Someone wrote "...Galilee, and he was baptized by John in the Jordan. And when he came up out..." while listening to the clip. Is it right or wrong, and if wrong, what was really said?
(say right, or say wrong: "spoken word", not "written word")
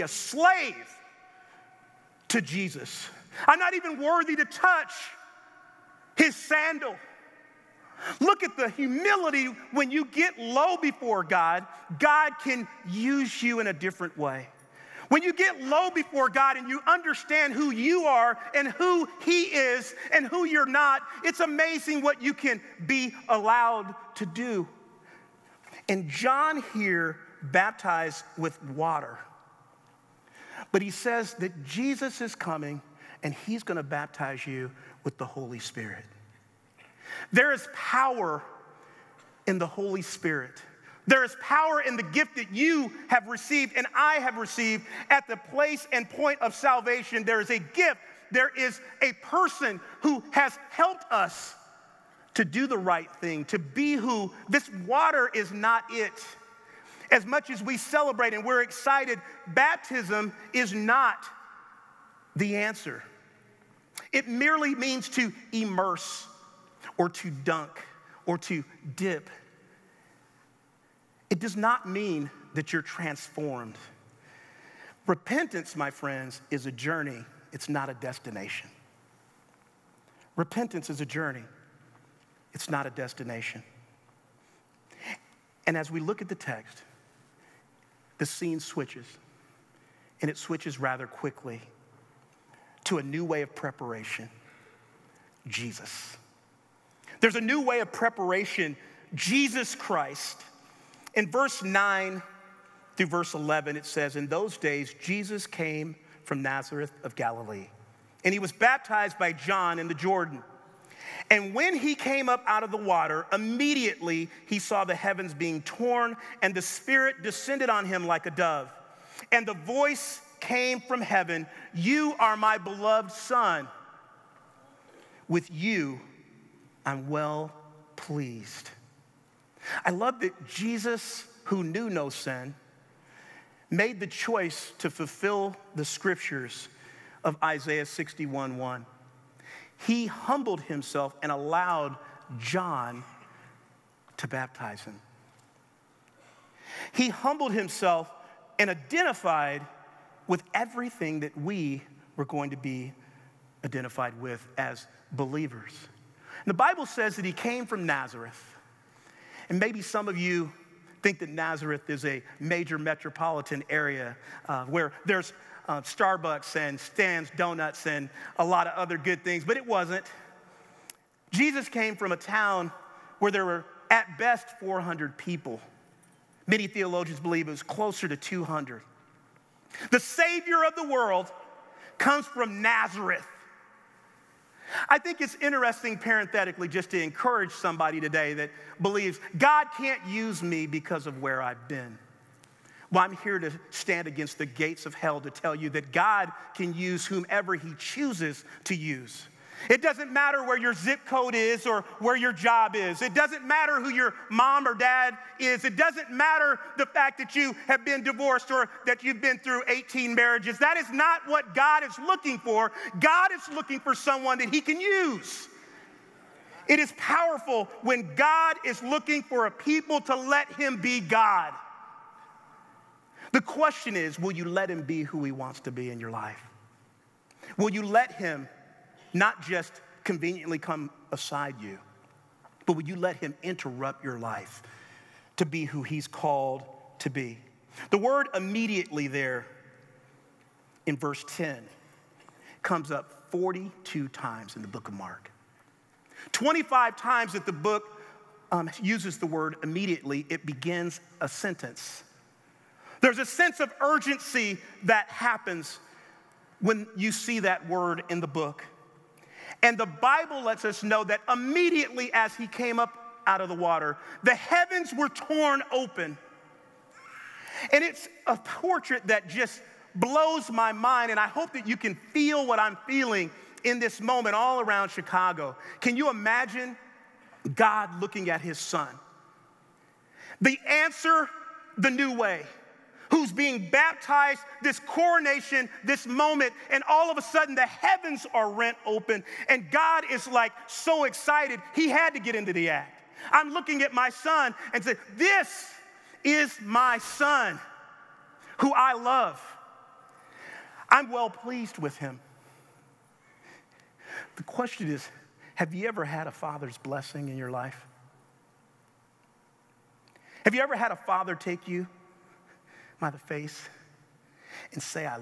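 right.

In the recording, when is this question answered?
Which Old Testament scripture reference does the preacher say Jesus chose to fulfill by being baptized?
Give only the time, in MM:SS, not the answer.
02:17.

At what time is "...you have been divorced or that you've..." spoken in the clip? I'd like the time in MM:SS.
03:27.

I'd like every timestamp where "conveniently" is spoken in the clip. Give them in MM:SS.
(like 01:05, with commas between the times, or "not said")
03:50.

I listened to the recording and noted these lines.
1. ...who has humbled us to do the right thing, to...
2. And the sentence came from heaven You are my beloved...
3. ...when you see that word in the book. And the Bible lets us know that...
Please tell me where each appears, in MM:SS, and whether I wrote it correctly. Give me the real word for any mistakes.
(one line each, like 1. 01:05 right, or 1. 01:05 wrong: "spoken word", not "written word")
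1. 00:50 wrong: "helped", not "humbled"
2. 01:59 wrong: "voice", not "sentence"
3. 04:16 right.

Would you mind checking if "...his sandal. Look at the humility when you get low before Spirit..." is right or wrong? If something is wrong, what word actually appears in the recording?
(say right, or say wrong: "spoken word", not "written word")
wrong: "God", not "Spirit".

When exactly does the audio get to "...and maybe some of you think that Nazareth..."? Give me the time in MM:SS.
02:39.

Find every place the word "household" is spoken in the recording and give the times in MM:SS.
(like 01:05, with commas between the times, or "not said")
not said.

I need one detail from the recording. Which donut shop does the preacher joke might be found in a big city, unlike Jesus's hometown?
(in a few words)
Stan's Donuts.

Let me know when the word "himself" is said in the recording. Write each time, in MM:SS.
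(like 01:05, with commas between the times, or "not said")
02:20, 02:27.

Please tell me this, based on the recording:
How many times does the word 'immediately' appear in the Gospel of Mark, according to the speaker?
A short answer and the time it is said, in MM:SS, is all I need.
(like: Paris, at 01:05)
42, at 04:03.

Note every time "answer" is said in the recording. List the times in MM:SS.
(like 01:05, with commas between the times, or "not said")
01:02, 04:40.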